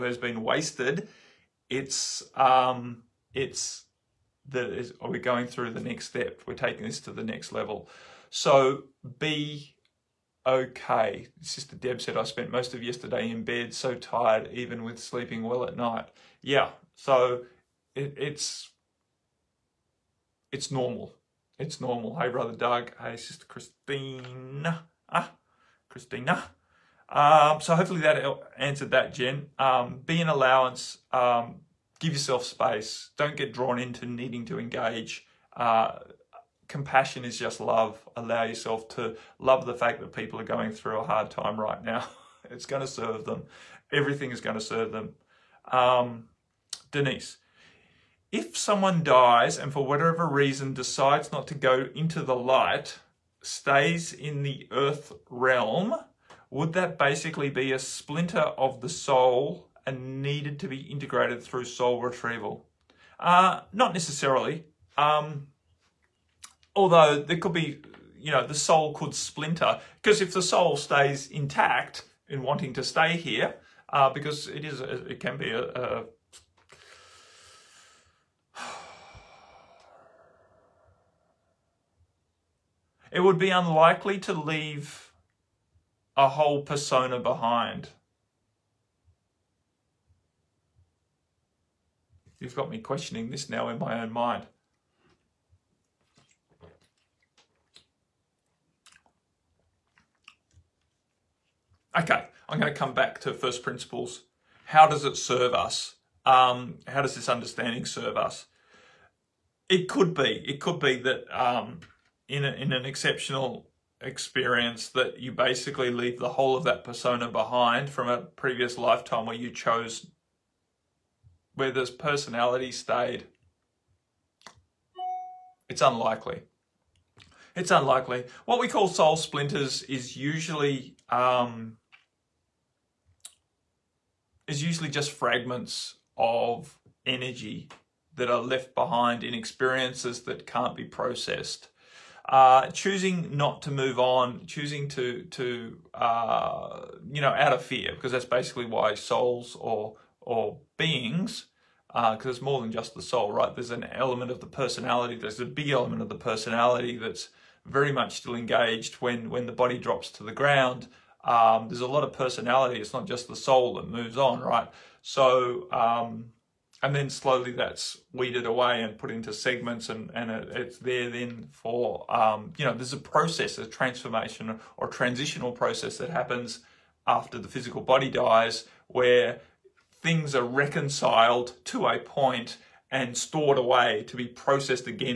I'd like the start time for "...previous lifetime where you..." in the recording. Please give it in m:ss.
1:58.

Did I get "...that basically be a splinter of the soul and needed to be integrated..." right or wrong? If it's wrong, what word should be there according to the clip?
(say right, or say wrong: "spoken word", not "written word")
right.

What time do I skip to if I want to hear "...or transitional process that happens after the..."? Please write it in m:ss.
2:54.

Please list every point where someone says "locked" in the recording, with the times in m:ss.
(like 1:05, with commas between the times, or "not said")
not said.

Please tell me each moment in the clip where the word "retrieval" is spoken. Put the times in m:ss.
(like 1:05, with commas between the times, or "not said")
1:02.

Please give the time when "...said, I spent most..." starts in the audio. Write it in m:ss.
0:11.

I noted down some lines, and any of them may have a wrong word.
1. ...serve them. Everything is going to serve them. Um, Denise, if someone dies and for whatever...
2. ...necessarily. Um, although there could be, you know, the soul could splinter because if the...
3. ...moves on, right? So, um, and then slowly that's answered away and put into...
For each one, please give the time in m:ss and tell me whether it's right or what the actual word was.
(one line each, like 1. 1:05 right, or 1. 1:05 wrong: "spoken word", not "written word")
1. 0:42 right
2. 1:03 right
3. 2:43 wrong: "weeded", not "answered".